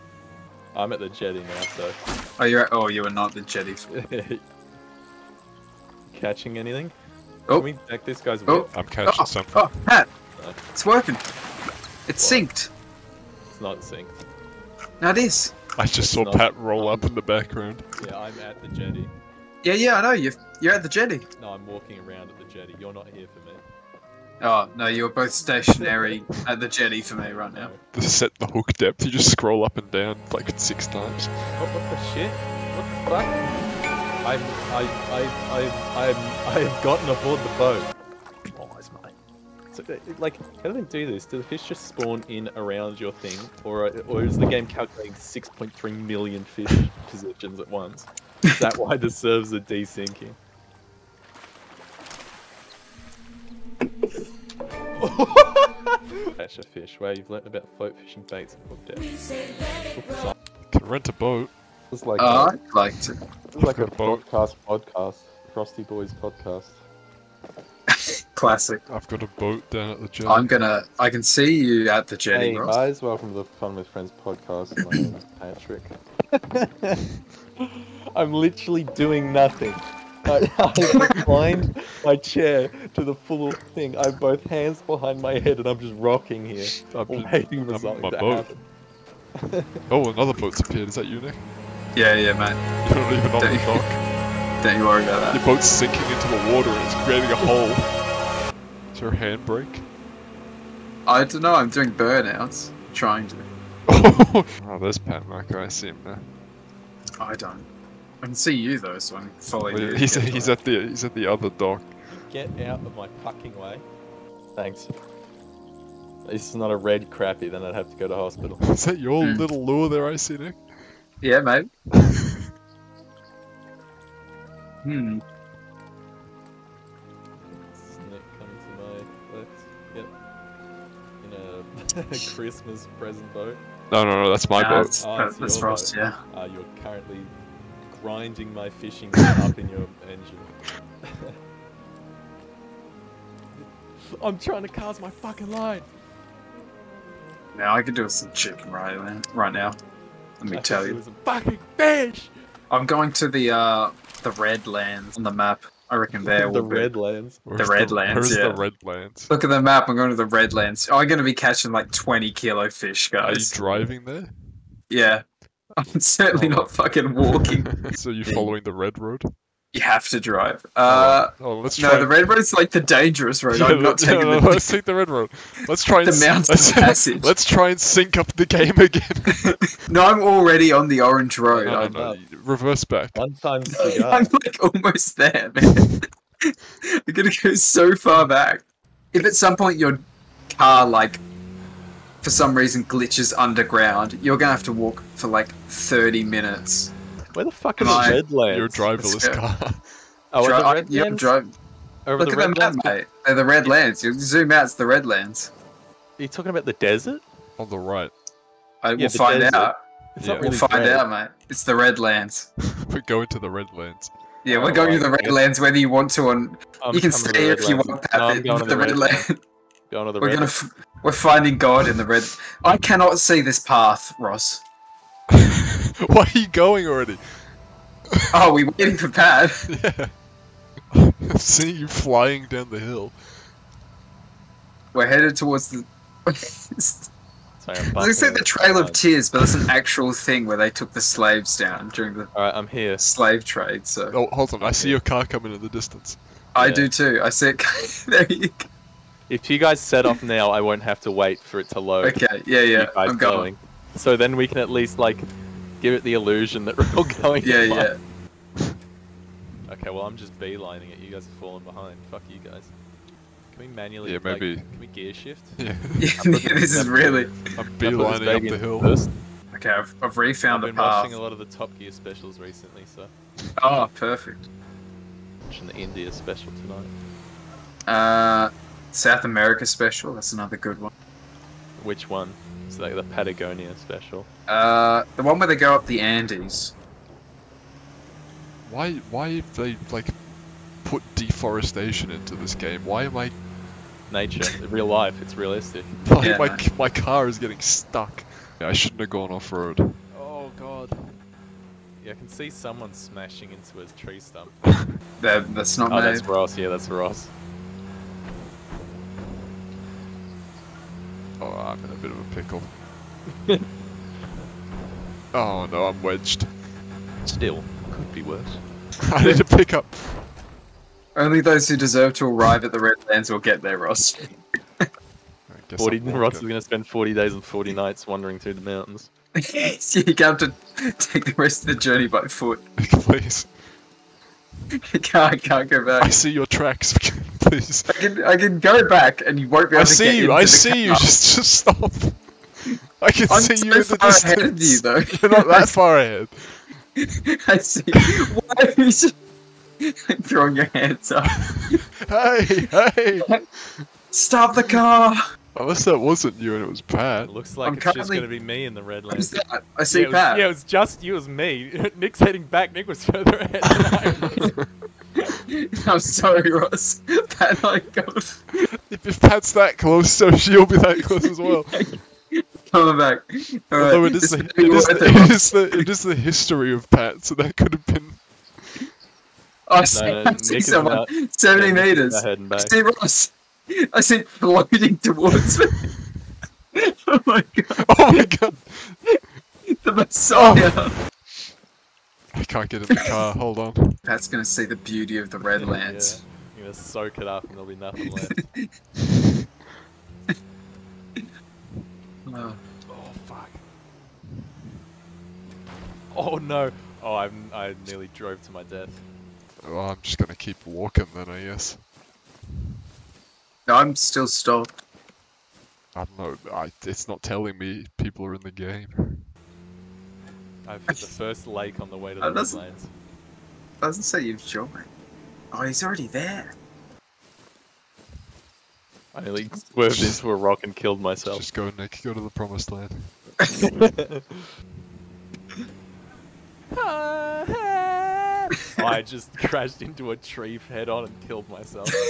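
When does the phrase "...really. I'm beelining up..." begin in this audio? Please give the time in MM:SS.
04:26.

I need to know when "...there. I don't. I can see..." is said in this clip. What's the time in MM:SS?
01:46.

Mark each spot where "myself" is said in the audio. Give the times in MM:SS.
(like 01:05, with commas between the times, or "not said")
07:10, 07:21.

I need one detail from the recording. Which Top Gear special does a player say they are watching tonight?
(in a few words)
The India special.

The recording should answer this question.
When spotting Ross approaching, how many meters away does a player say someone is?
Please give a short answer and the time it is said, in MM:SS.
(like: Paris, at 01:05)
70 meters, at 06:21.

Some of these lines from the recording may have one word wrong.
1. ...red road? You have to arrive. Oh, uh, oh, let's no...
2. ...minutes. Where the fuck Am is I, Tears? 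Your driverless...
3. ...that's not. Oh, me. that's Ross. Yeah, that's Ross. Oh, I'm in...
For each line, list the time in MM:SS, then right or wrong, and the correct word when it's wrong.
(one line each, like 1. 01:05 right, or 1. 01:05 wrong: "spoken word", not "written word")
1. 02:48 wrong: "drive", not "arrive"
2. 03:16 wrong: "Redlands", not "Tears"
3. 05:05 right.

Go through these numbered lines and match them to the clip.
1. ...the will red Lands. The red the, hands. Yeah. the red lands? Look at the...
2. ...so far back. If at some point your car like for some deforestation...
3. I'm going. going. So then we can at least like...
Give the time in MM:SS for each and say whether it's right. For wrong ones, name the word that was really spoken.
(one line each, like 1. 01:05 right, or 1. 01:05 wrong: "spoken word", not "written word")
1. 02:36 wrong: "lands", not "hands"
2. 03:07 wrong: "reason", not "deforestation"
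3. 04:12 right.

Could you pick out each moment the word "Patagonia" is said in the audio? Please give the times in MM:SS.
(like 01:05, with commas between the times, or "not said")
04:43.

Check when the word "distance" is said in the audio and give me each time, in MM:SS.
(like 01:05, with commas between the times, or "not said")
04:05, 05:43.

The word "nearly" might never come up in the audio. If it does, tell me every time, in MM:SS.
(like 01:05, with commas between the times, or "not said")
06:47, 07:09.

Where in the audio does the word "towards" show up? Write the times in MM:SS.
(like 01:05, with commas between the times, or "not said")
03:55, 06:24.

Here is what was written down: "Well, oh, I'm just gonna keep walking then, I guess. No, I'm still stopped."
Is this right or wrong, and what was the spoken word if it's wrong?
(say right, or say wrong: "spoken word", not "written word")
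right.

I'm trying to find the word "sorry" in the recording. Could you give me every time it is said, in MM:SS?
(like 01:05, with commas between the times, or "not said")
03:56, 06:05.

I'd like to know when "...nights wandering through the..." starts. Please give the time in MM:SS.
05:27.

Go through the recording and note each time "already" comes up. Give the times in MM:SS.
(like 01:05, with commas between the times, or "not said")
03:00, 03:46, 07:05.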